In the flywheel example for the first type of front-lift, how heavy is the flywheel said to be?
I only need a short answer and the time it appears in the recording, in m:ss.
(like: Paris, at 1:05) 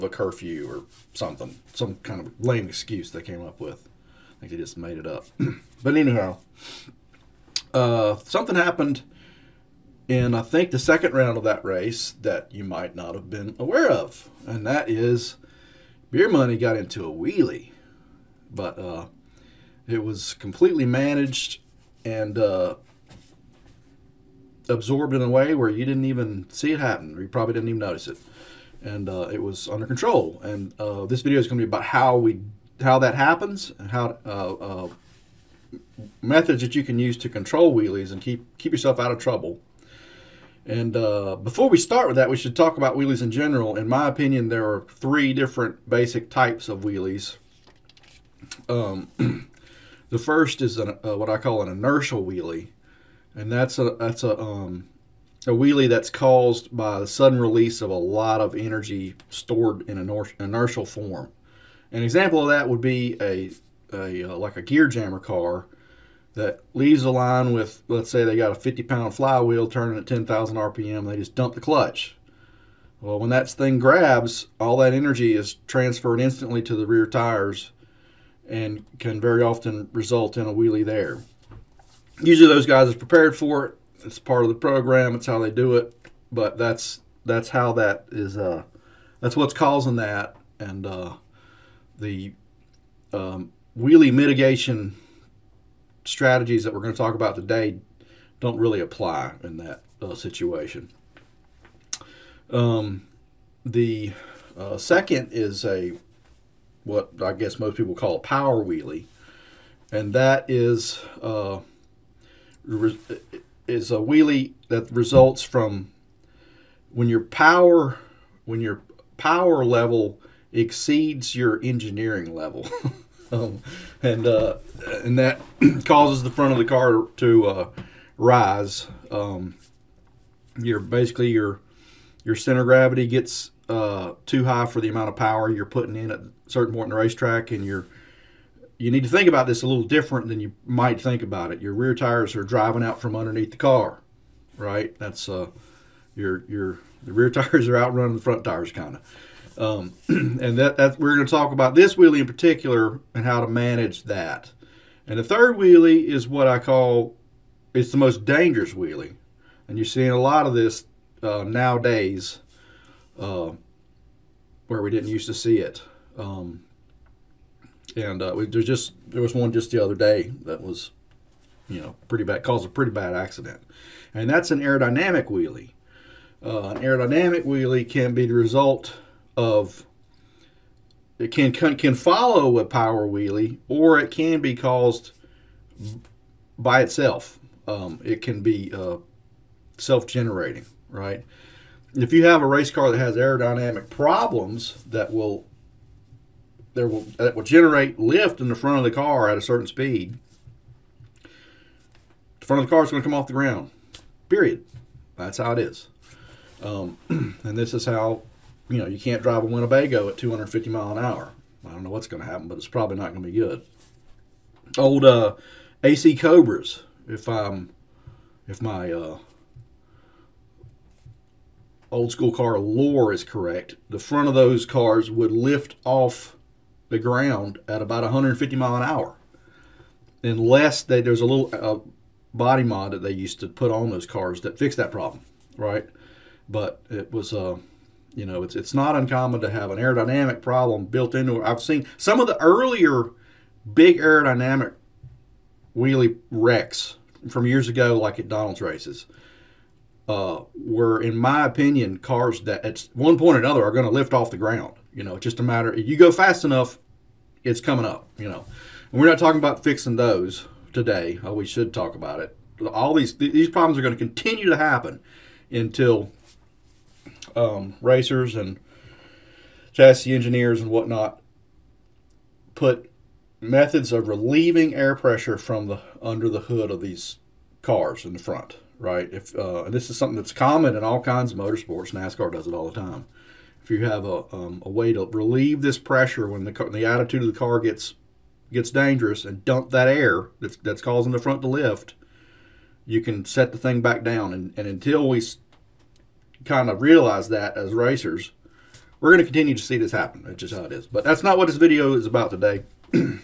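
50 pounds, at 1:08.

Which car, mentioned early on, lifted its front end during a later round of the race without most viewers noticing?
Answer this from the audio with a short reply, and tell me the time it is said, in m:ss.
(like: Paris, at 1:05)
Beer Money, at 0:16.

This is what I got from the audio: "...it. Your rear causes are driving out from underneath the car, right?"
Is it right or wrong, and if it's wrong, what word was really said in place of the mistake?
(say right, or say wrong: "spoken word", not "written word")
wrong: "tires", not "causes".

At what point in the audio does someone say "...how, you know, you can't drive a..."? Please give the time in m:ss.
3:27.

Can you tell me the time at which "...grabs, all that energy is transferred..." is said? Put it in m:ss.
1:13.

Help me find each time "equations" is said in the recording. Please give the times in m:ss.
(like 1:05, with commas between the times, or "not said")
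not said.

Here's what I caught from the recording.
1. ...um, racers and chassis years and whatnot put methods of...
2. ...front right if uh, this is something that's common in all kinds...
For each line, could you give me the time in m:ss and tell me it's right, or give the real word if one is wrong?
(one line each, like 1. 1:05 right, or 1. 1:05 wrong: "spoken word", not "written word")
1. 4:27 wrong: "engineers", not "years"
2. 4:38 right.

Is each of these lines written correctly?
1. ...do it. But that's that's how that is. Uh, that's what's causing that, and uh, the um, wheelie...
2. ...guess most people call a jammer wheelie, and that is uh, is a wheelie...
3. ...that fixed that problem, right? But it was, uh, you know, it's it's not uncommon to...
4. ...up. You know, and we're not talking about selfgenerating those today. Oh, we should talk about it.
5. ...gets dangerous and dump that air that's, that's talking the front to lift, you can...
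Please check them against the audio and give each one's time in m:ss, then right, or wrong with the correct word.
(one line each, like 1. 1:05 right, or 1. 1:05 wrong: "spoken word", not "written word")
1. 1:25 right
2. 1:47 wrong: "power", not "jammer"
3. 3:54 right
4. 4:17 wrong: "fixing", not "selfgenerating"
5. 4:48 wrong: "causing", not "talking".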